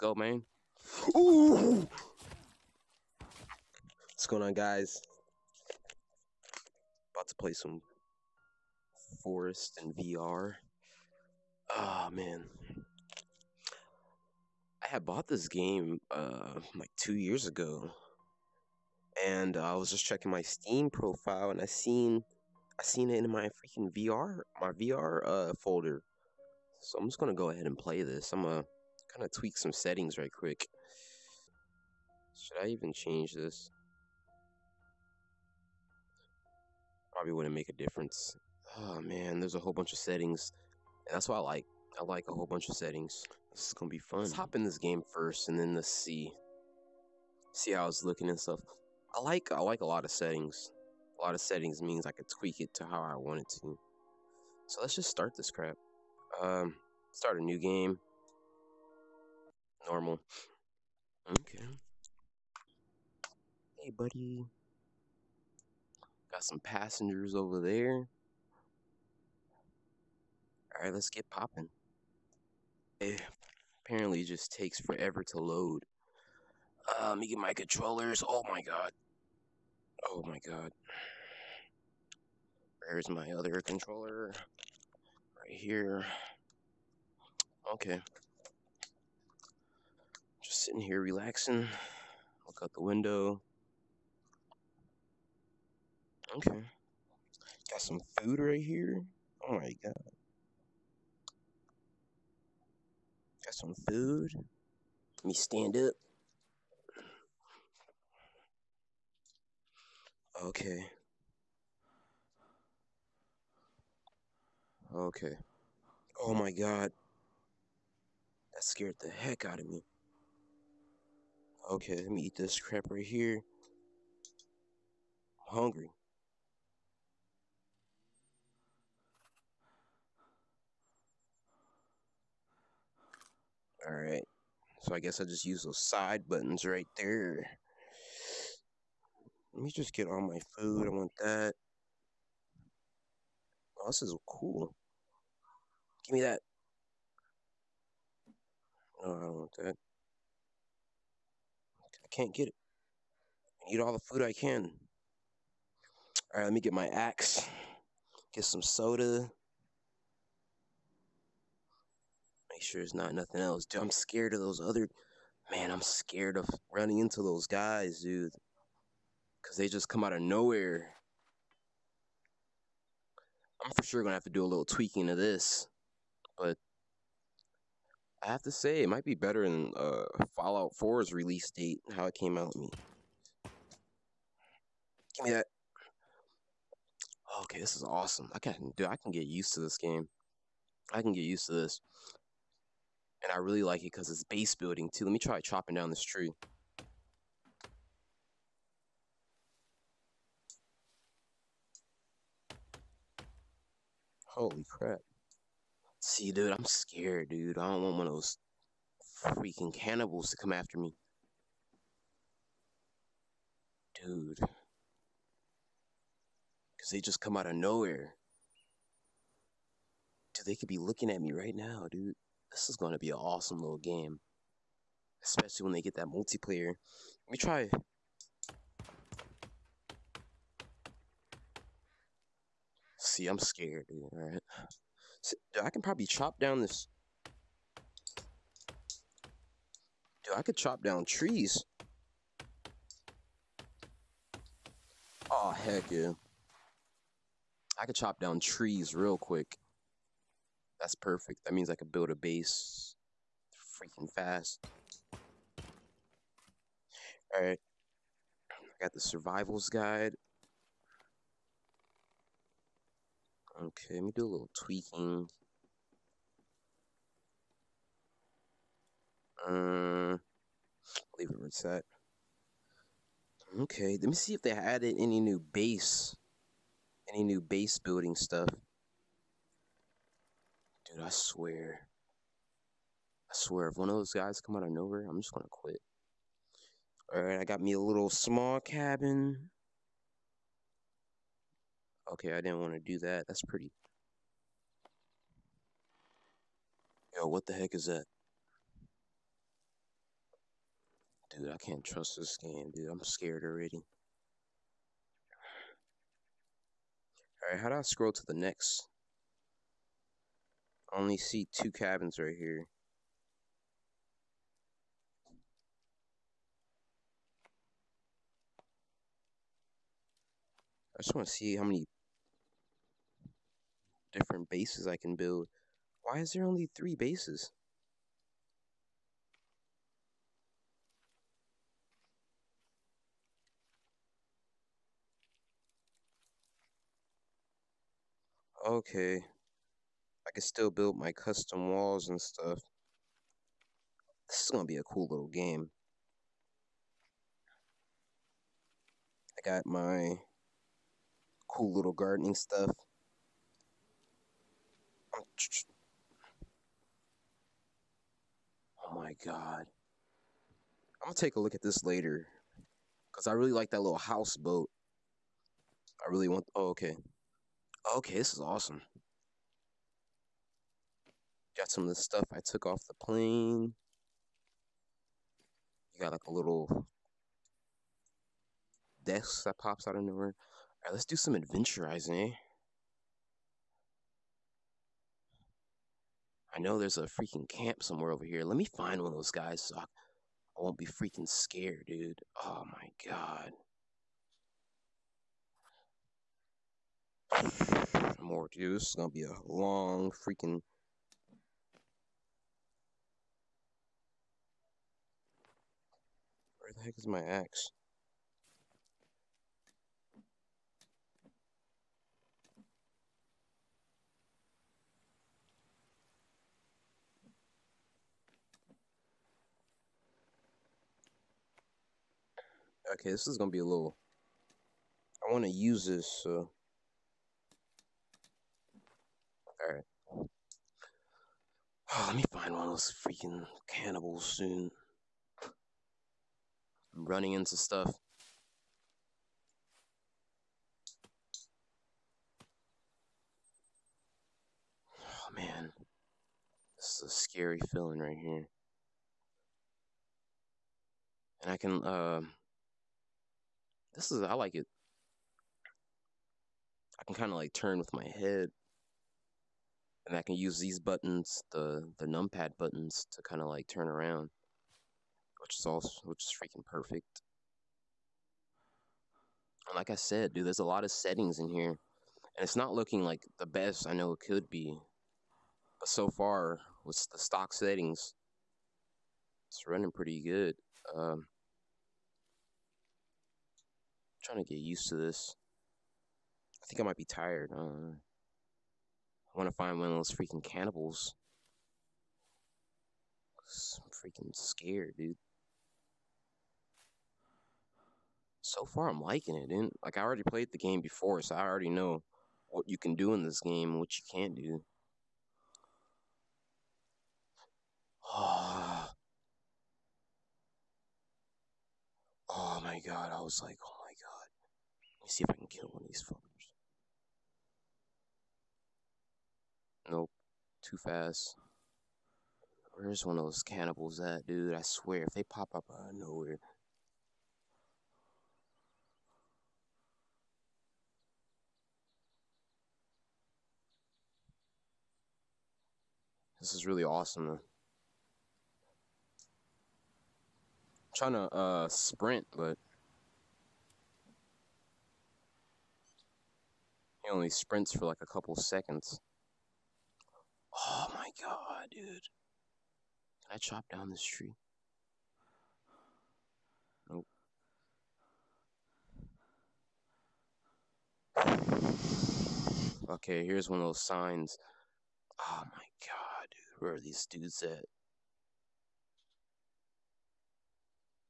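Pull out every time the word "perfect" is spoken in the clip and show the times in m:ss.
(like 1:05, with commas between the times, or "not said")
4:10, 7:46.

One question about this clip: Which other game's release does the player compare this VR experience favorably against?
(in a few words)
Fallout 4.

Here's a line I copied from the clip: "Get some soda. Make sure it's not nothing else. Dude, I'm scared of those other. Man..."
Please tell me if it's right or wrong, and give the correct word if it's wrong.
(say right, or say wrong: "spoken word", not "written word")
right.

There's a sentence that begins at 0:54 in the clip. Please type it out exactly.
So let's just start this crap.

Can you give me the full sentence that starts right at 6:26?
I know there's a freaking camp somewhere over here.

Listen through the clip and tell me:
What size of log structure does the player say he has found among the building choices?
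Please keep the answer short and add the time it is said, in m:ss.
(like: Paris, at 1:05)
Small cabin, at 4:48.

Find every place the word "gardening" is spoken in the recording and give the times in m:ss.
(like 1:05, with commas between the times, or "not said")
5:51.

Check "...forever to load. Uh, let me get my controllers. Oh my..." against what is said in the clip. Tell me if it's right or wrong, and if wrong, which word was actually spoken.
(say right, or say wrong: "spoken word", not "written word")
right.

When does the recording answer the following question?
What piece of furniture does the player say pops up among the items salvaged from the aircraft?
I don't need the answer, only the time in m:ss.
6:16.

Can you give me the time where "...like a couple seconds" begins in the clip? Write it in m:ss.
9:07.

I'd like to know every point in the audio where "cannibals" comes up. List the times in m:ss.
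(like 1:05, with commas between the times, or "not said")
3:29, 7:13, 8:10, 8:43.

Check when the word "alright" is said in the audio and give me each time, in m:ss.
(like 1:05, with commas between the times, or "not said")
2:13, 3:54, 4:17, 5:07, 6:20.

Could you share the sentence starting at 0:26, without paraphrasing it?
So I'm just gonna go ahead and play this.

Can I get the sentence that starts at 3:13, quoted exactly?
And I really like it because it's base building too.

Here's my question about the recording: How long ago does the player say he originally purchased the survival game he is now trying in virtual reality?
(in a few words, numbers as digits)
2 years ago.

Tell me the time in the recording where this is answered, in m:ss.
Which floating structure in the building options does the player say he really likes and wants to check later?
6:03.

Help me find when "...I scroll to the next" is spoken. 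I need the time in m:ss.
5:07.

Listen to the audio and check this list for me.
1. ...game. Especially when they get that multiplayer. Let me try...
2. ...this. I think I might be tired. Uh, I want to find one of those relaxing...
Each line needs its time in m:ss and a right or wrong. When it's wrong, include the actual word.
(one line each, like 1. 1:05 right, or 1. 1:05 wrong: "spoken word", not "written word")
1. 3:43 right
2. 8:04 wrong: "freaking", not "relaxing".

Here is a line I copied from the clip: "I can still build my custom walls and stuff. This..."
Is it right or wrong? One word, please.
right.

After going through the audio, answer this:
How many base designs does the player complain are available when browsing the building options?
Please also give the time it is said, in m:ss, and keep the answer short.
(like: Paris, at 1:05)
3, at 5:26.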